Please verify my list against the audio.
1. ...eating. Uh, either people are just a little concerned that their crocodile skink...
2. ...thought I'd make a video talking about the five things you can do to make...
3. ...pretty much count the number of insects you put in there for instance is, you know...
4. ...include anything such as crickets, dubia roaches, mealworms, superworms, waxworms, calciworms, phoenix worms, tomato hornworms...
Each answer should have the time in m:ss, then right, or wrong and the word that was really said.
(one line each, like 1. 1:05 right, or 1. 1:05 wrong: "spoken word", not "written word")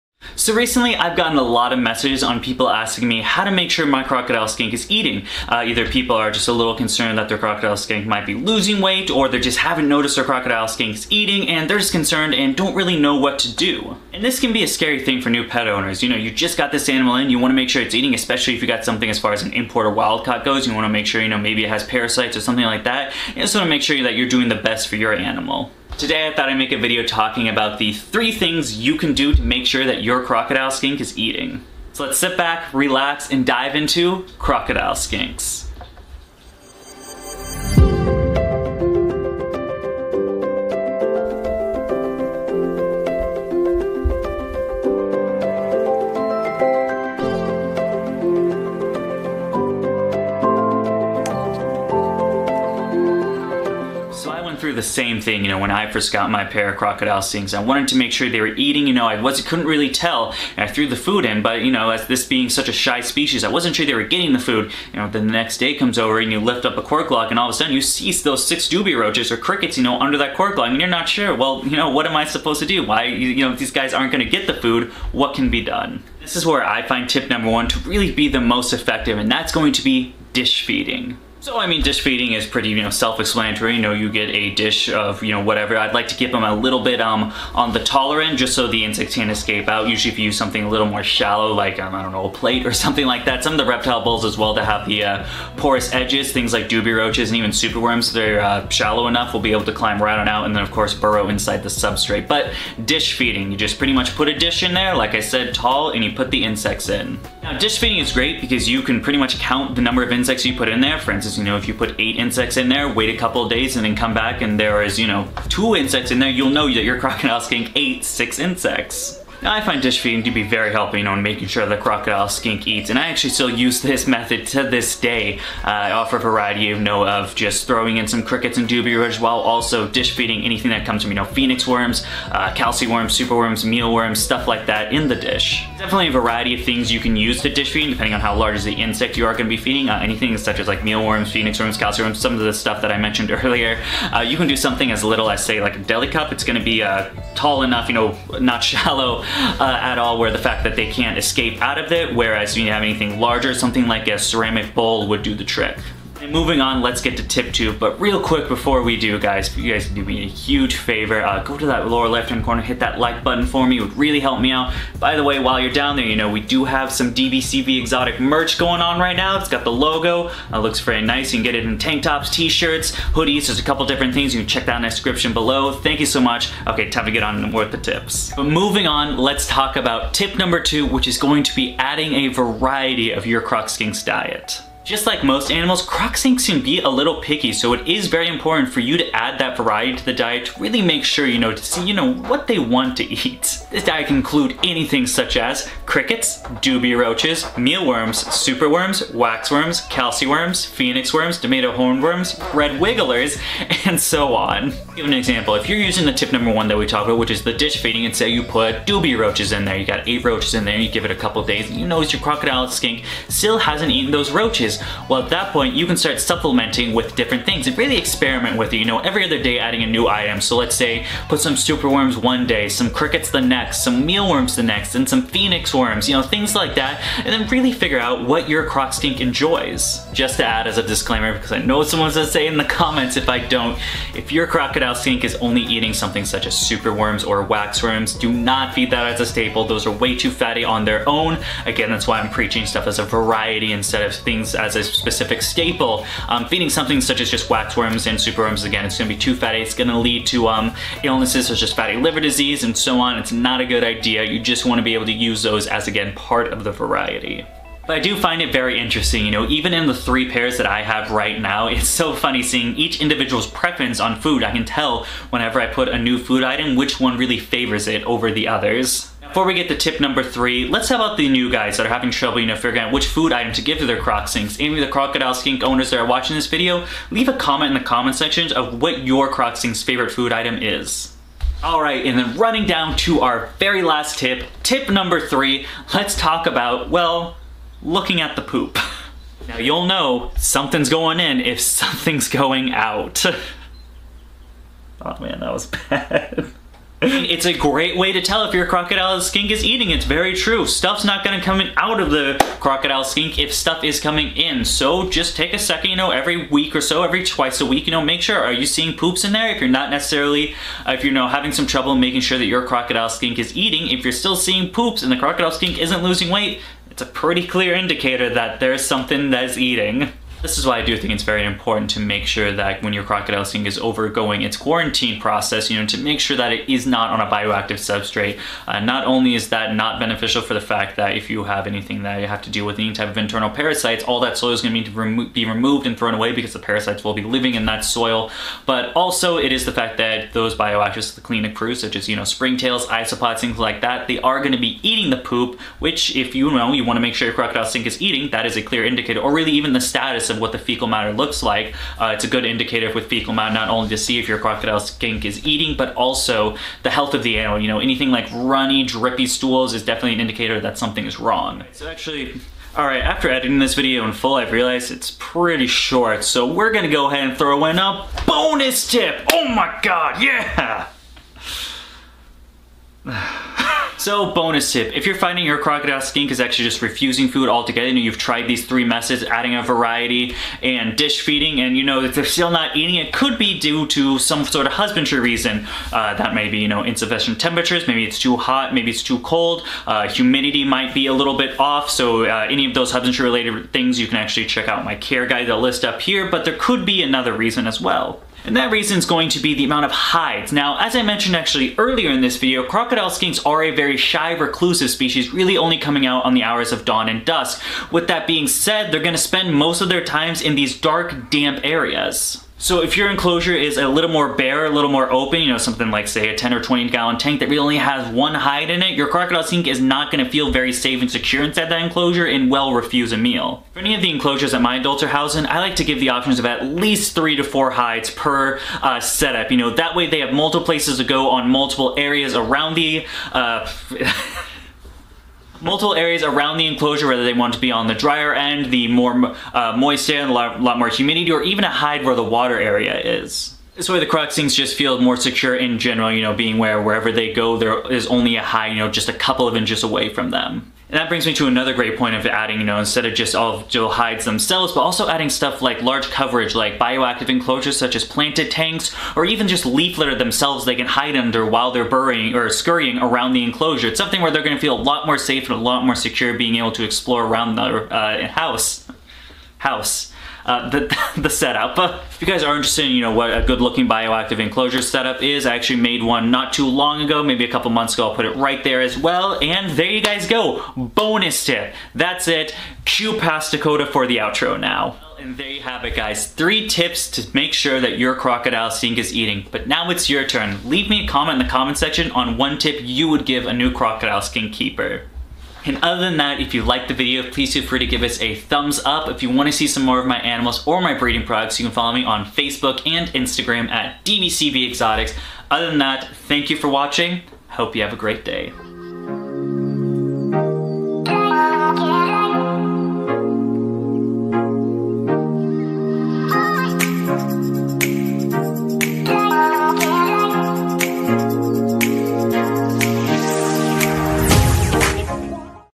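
1. 0:04 right
2. 0:26 wrong: "three", not "five"
3. 1:49 right
4. 3:14 right.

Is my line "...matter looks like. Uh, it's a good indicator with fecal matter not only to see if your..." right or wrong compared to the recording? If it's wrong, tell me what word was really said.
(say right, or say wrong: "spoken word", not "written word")
right.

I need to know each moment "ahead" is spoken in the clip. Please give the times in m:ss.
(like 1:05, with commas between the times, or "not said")
6:07.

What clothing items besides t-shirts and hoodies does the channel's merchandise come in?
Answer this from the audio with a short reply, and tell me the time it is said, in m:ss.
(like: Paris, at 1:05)
Tank tops, at 2:51.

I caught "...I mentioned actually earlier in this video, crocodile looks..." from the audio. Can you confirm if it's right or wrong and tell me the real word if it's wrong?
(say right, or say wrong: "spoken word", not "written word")
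wrong: "skinks", not "looks".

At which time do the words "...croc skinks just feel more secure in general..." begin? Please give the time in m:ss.
7:24.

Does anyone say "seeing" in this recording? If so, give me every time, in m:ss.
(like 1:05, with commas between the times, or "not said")
4:22, 5:08, 5:14.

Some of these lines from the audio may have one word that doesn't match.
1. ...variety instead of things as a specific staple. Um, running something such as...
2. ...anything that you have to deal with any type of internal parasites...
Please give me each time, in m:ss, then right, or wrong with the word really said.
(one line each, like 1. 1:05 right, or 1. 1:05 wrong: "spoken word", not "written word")
1. 4:03 wrong: "feeding", not "running"
2. 5:31 right.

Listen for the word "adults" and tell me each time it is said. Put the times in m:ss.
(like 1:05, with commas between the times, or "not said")
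7:04.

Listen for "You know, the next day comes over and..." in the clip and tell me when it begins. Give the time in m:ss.
1:04.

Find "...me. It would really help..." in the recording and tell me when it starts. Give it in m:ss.
2:43.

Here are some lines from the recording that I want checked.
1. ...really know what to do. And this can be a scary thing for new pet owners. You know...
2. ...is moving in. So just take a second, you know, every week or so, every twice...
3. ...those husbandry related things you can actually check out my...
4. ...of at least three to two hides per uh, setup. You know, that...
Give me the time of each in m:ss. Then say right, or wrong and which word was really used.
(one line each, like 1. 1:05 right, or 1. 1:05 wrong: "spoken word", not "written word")
1. 0:12 right
2. 5:03 wrong: "coming", not "moving"
3. 6:32 right
4. 7:06 wrong: "four", not "two".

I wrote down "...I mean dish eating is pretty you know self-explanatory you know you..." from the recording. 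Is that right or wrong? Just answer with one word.
wrong.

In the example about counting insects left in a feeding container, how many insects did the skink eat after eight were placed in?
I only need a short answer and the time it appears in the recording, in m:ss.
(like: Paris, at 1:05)
6, at 1:58.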